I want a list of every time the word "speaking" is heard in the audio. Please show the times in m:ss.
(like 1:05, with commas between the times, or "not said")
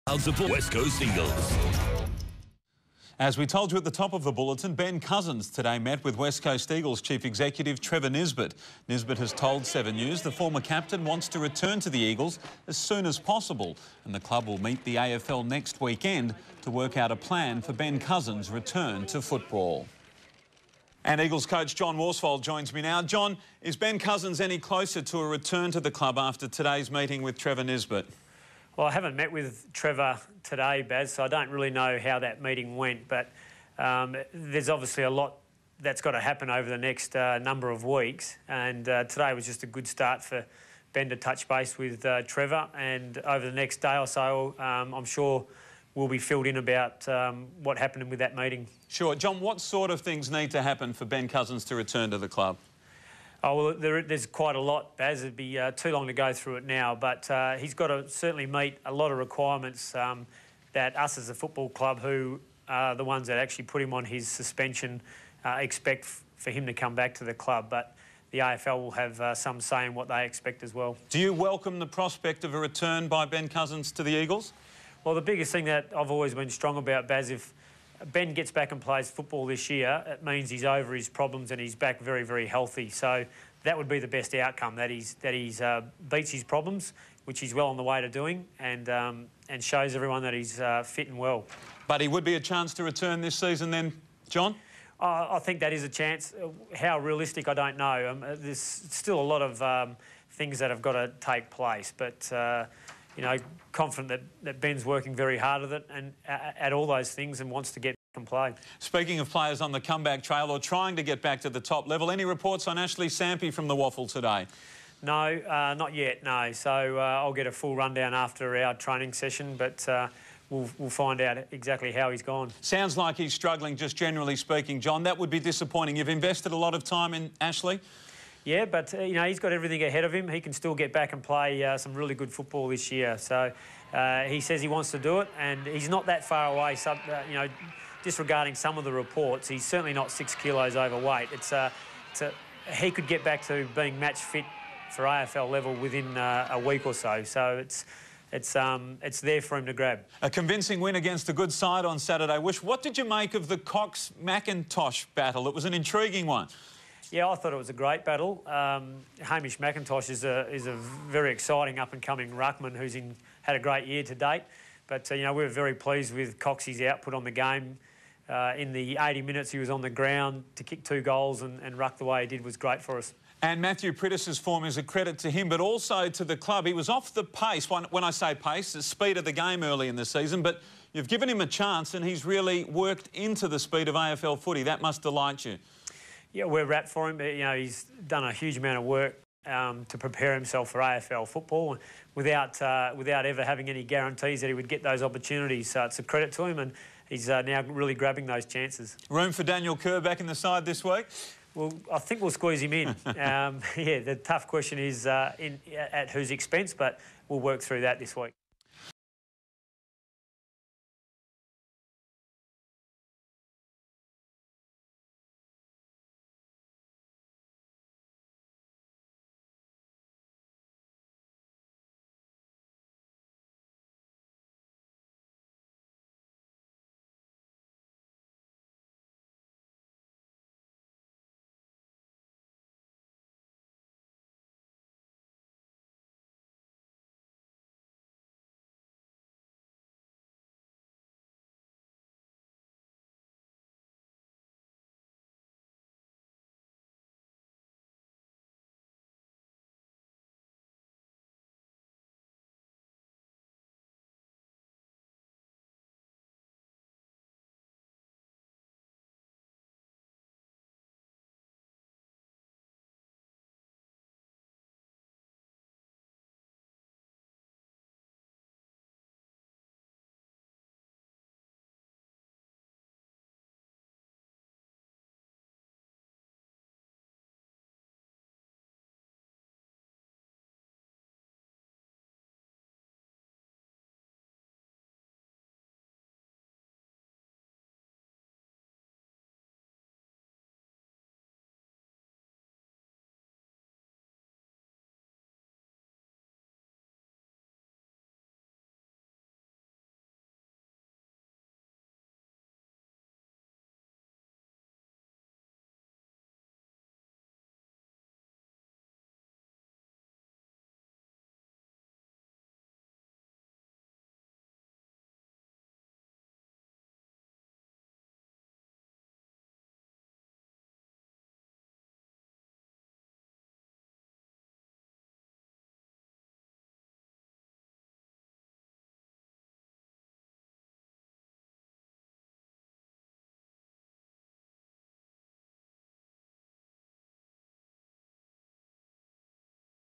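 1:48, 2:04.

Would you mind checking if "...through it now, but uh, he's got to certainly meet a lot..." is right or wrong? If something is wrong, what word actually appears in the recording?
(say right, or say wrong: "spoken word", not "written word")
right.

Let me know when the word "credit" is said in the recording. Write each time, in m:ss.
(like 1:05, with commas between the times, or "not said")
2:54, 3:16.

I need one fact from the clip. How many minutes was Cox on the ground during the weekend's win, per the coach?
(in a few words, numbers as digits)
80.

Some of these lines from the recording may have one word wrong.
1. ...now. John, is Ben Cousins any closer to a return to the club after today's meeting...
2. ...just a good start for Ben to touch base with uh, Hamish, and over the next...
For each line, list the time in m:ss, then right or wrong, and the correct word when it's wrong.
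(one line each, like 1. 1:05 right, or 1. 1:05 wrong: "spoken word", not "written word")
1. 0:22 right
2. 0:39 wrong: "Trevor", not "Hamish".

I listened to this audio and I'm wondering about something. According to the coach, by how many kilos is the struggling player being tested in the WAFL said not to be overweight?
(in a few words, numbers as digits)
6.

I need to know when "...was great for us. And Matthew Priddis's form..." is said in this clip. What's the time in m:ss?
2:52.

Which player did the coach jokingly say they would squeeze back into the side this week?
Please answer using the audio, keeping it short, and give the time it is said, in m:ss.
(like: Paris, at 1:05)
Daniel Kerr, at 3:19.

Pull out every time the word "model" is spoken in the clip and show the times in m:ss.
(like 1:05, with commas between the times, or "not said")
not said.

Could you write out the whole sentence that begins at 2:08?
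Yeah, but uh, you know he's got everything ahead of him.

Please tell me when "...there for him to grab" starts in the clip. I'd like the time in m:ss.
2:29.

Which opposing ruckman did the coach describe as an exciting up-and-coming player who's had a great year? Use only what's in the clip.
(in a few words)
Hamish McIntosh.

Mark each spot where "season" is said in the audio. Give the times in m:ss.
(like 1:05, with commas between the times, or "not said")
1:33, 3:00.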